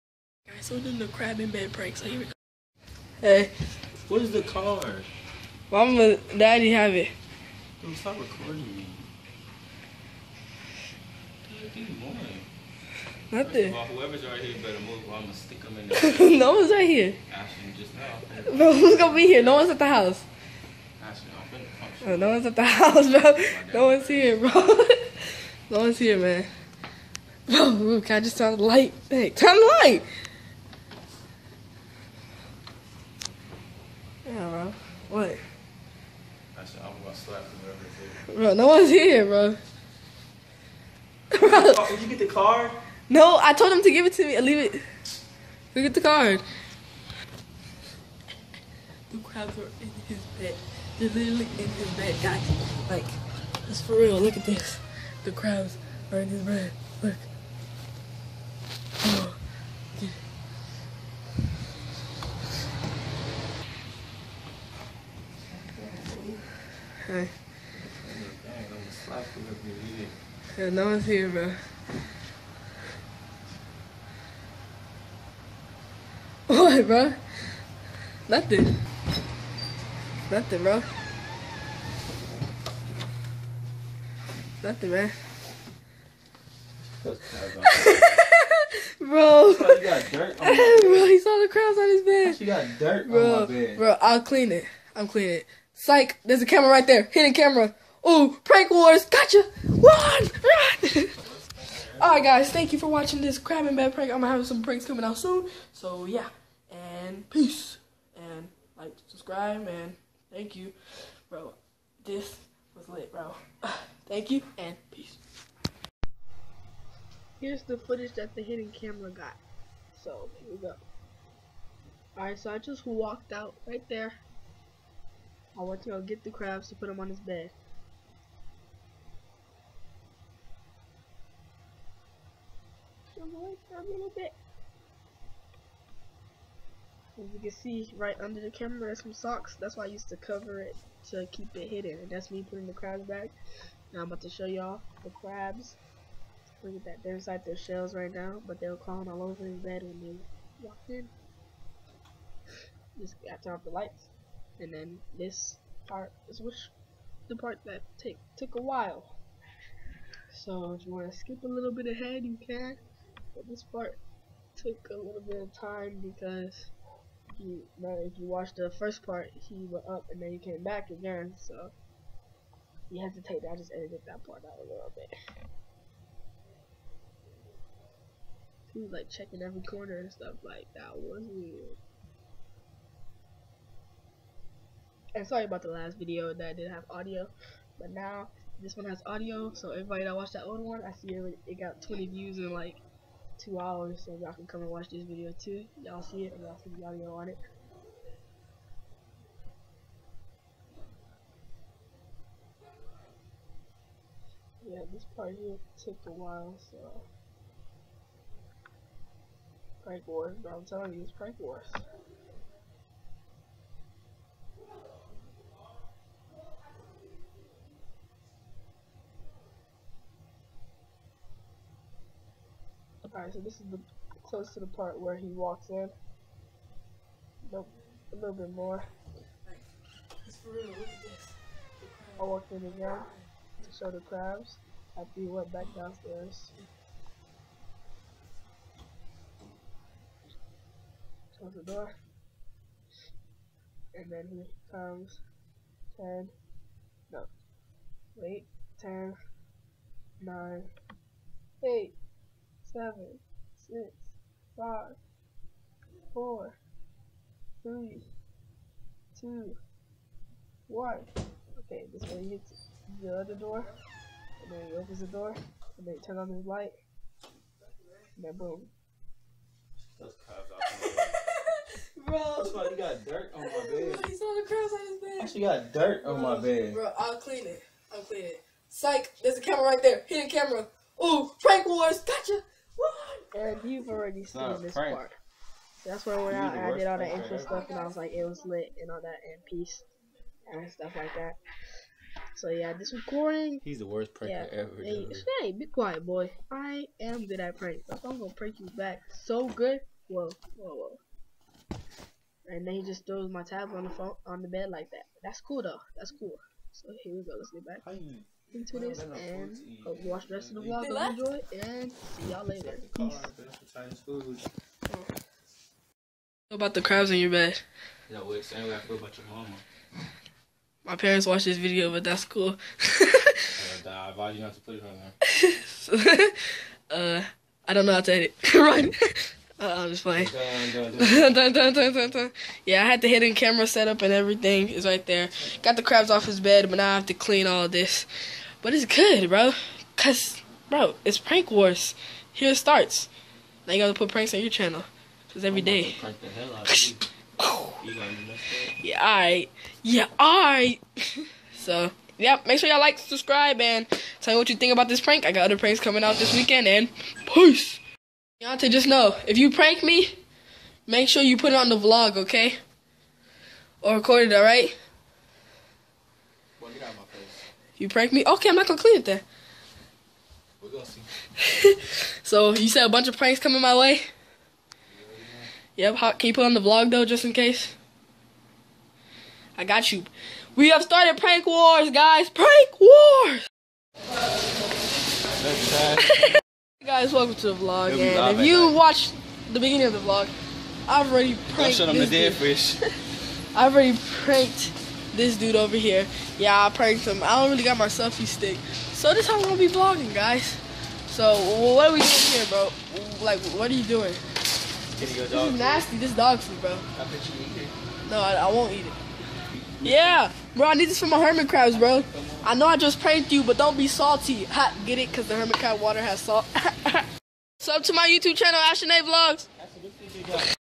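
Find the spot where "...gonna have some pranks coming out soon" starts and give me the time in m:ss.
1:44.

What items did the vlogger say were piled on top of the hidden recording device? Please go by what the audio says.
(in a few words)
socks.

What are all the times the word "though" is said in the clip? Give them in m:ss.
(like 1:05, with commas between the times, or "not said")
5:05, 6:16.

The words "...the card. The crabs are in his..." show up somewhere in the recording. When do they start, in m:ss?
0:45.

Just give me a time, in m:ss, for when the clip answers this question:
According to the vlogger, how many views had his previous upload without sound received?
3:11.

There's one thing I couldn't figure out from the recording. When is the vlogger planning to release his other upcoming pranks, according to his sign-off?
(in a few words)
this weekend.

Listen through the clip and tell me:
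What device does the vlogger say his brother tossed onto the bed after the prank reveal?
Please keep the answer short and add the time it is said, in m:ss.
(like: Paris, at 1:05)
tablet, at 5:03.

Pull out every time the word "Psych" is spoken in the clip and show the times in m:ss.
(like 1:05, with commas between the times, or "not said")
1:35, 4:38.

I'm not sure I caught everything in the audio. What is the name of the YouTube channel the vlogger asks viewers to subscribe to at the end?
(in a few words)
Ashton A Vlogs.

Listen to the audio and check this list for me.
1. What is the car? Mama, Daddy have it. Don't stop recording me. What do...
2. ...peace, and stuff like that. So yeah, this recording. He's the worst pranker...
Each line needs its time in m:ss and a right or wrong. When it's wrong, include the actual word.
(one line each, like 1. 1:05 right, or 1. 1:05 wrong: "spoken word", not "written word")
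1. 0:04 right
2. 4:49 right.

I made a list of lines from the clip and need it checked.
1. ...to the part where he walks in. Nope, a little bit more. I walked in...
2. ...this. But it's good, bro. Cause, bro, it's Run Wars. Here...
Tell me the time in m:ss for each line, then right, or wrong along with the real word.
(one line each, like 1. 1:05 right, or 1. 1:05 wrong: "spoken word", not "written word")
1. 3:44 right
2. 5:37 wrong: "Prank", not "Run".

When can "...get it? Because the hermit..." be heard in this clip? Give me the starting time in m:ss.
6:54.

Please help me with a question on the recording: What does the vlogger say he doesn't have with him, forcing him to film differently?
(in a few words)
selfie stick.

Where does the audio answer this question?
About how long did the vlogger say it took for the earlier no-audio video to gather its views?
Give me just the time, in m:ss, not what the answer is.
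3:13.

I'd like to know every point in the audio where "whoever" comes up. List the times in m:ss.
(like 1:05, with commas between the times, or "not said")
0:13, 0:37.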